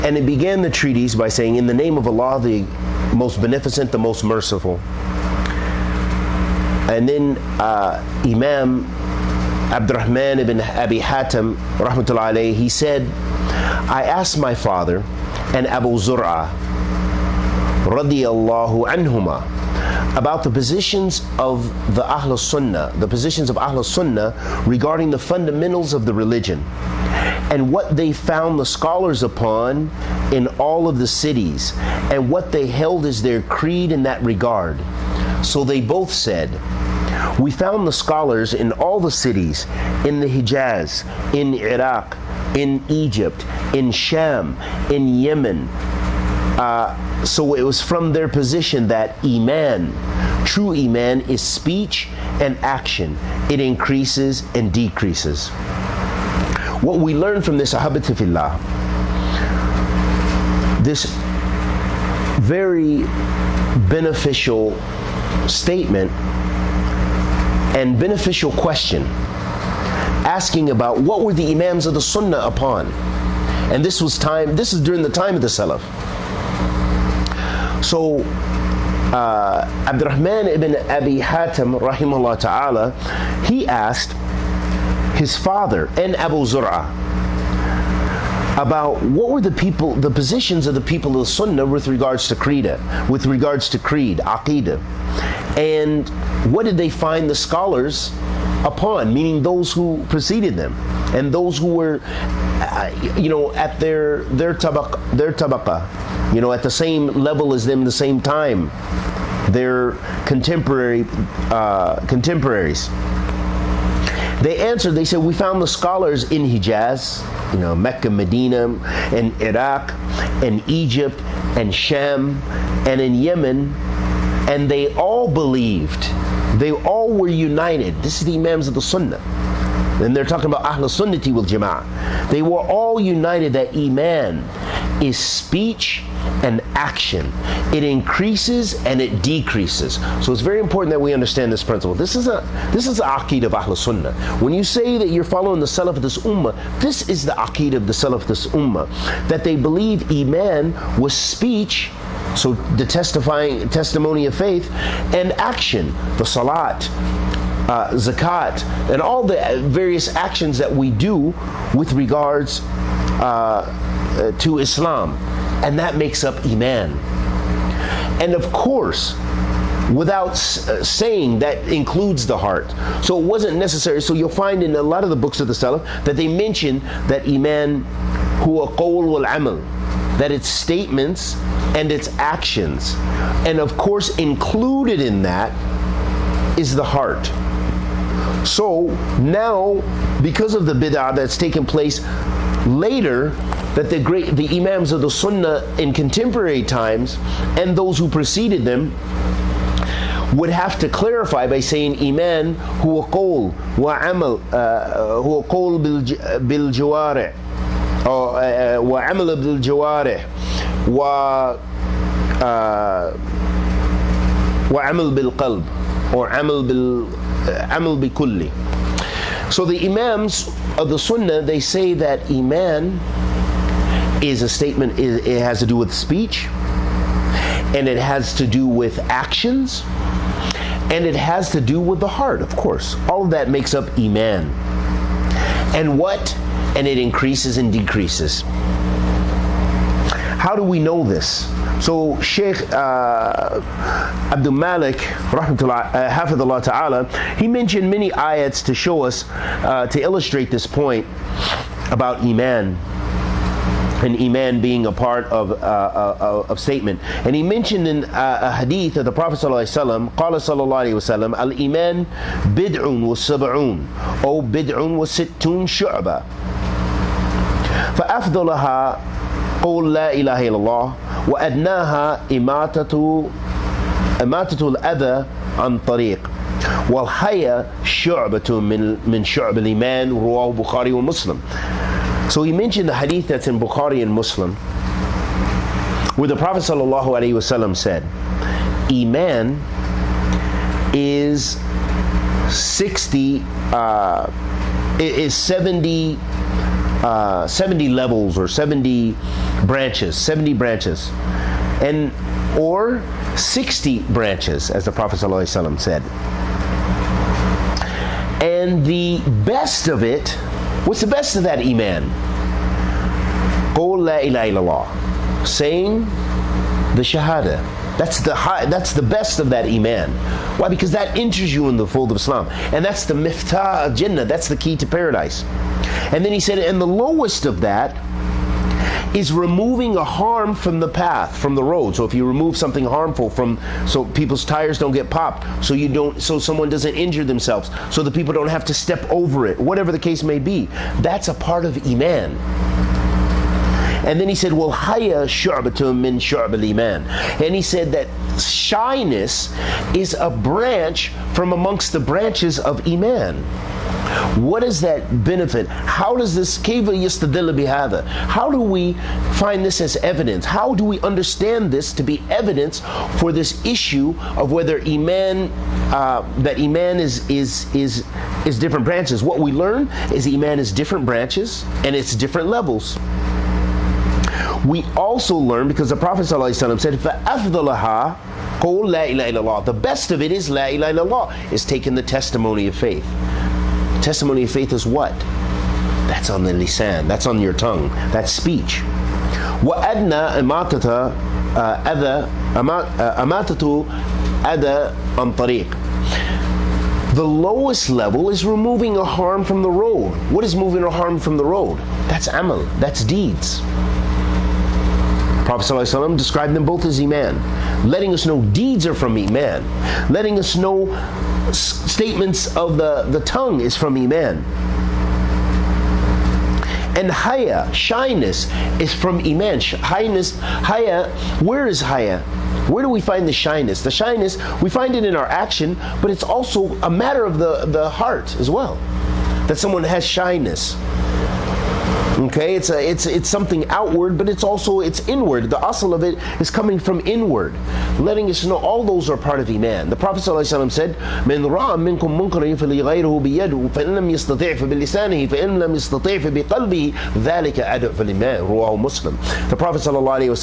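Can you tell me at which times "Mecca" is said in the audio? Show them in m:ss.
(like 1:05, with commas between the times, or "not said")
1:57.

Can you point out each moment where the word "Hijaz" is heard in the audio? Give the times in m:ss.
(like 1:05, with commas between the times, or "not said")
0:40, 1:56.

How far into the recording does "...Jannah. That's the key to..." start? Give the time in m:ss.
5:23.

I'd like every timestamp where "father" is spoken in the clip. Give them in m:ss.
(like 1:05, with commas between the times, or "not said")
0:14, 1:25.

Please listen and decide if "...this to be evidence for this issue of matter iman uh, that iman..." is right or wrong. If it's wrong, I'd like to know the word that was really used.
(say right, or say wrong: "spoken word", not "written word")
wrong: "whether", not "matter".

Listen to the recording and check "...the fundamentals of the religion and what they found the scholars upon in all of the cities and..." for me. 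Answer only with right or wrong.
right.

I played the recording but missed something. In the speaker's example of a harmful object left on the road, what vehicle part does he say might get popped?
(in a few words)
tires.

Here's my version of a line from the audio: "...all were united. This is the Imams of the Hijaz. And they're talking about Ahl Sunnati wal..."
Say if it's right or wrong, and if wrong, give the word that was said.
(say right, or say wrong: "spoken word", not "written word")
wrong: "Sunnah", not "Hijaz".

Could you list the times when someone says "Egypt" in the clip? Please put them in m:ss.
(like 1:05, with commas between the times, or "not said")
0:42, 2:00.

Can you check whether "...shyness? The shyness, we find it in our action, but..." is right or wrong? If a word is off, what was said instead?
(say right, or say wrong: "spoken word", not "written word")
right.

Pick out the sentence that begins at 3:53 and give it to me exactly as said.
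All of that makes up Iman.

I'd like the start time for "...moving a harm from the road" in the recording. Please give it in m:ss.
6:40.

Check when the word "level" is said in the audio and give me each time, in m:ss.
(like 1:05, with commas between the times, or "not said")
1:47, 4:57, 6:12, 6:37.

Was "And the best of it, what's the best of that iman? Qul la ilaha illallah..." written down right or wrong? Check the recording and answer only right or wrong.
right.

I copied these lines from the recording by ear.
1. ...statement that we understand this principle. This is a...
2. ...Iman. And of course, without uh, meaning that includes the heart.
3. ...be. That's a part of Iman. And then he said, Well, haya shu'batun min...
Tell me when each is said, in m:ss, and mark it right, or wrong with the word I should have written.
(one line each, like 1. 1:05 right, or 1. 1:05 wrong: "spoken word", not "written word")
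1. 2:20 wrong: "important", not "statement"
2. 2:46 wrong: "saying", not "meaning"
3. 5:40 right.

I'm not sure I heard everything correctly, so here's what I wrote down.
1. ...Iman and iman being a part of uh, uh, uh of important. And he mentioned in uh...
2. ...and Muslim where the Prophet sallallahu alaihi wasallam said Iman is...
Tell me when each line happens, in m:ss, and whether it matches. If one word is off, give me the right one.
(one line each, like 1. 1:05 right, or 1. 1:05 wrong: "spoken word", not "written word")
1. 4:12 wrong: "statement", not "important"
2. 4:44 right.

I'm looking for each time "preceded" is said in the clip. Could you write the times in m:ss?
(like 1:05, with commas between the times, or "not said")
1:40, 3:18.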